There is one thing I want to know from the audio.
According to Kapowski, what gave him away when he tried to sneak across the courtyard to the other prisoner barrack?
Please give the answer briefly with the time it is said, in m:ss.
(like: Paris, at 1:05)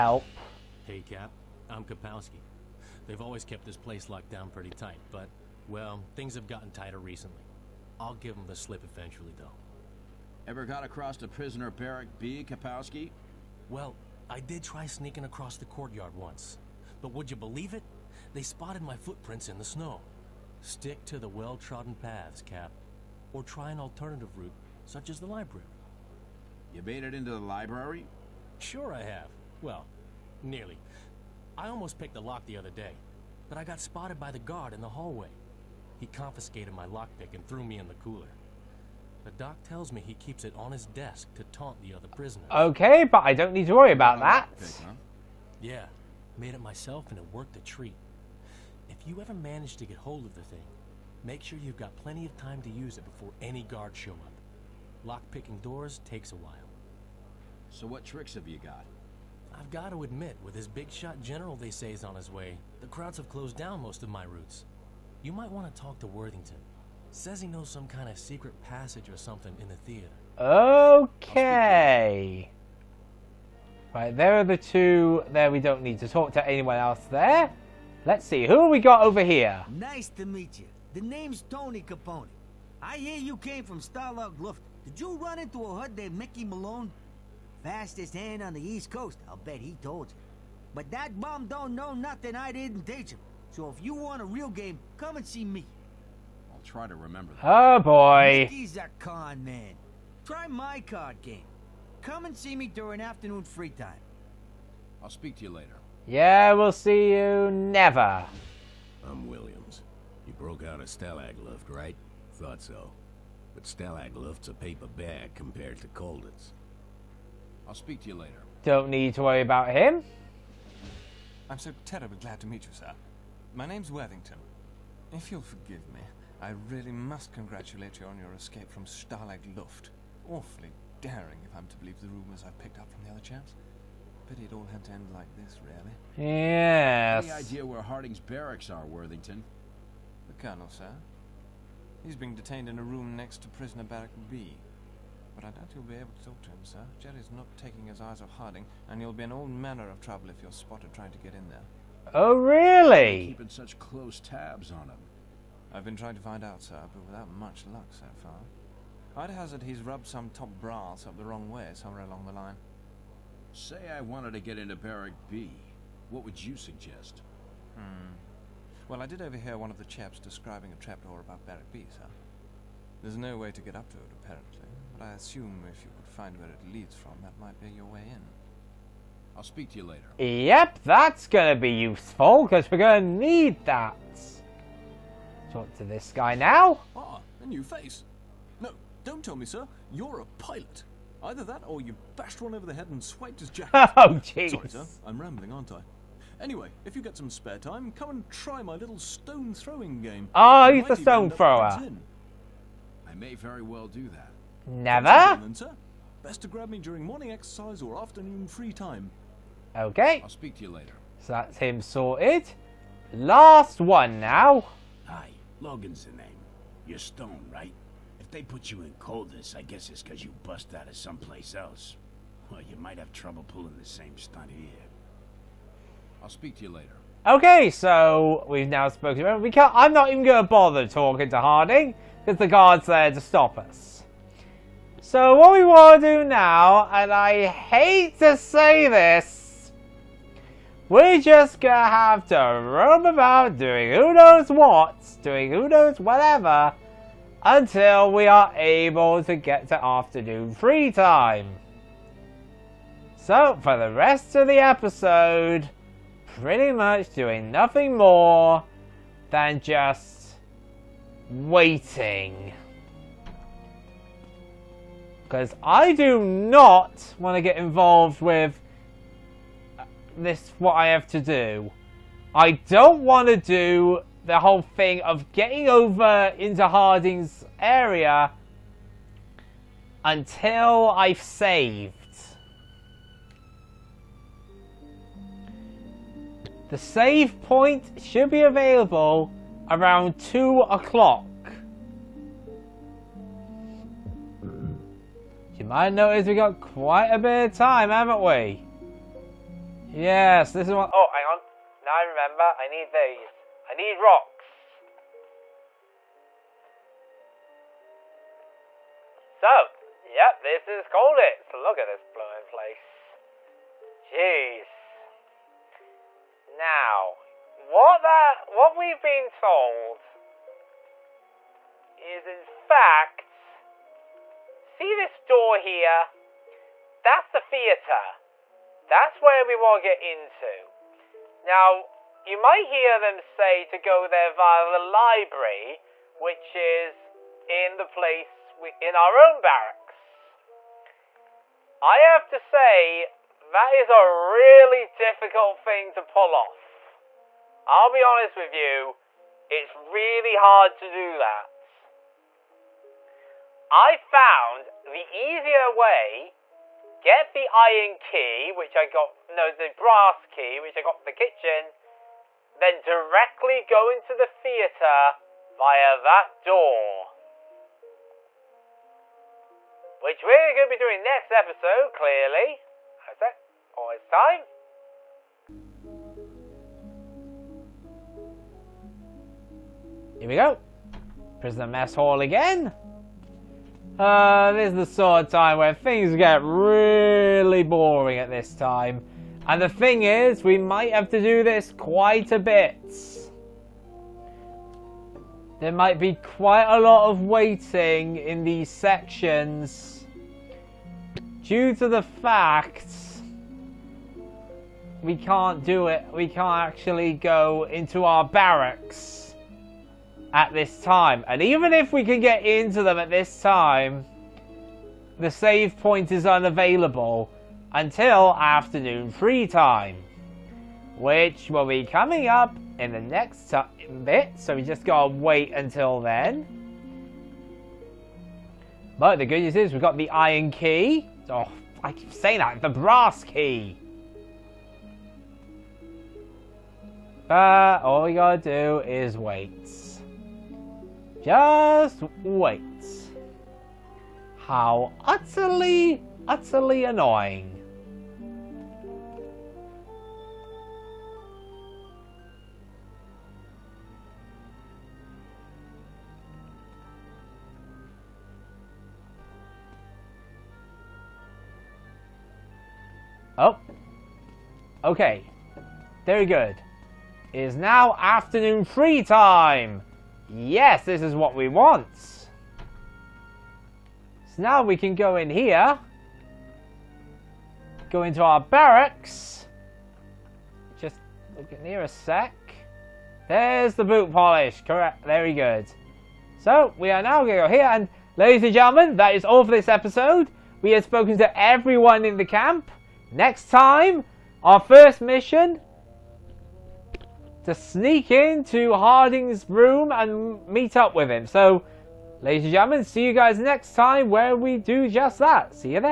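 Footprints in the snow, at 0:18.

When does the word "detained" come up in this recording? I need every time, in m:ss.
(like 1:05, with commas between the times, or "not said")
2:22.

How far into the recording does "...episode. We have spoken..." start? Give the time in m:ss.
8:09.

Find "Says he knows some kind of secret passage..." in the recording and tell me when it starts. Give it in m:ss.
1:07.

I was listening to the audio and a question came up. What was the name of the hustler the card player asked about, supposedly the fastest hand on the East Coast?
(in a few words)
Mickey Malone.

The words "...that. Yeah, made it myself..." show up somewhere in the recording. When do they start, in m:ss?
0:44.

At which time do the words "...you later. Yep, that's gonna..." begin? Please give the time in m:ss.
2:59.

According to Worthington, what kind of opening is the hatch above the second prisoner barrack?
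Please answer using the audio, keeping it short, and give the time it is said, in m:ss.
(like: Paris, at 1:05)
A trapdoor, at 2:50.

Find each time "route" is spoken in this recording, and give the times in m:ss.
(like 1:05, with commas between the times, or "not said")
0:24, 1:04.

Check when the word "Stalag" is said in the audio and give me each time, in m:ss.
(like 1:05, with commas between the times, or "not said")
1:23, 1:53, 2:08.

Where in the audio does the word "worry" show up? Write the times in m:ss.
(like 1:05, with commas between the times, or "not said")
0:43, 1:59.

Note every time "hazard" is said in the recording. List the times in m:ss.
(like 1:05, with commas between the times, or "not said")
2:39.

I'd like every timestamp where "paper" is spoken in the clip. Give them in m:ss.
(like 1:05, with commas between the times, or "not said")
1:54.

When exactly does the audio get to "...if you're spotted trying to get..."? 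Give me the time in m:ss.
2:30.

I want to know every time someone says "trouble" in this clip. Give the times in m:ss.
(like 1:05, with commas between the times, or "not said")
2:29, 3:43.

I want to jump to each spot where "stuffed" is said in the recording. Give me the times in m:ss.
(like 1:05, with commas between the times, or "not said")
not said.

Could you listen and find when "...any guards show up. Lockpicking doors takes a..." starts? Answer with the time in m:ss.
0:53.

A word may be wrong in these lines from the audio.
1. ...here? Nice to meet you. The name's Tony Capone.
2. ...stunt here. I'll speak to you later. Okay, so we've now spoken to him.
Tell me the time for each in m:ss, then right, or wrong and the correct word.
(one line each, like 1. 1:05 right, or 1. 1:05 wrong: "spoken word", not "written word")
1. 1:19 right
2. 3:44 right.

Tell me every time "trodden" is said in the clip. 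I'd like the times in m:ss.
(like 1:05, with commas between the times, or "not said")
0:21.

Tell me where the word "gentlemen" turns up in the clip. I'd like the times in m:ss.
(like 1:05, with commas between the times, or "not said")
8:08, 8:22.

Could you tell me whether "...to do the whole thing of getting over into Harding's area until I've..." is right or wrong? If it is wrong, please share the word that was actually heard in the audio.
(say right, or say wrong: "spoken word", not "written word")
right.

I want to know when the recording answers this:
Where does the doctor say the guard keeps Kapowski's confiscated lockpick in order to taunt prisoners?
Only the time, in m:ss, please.
0:40.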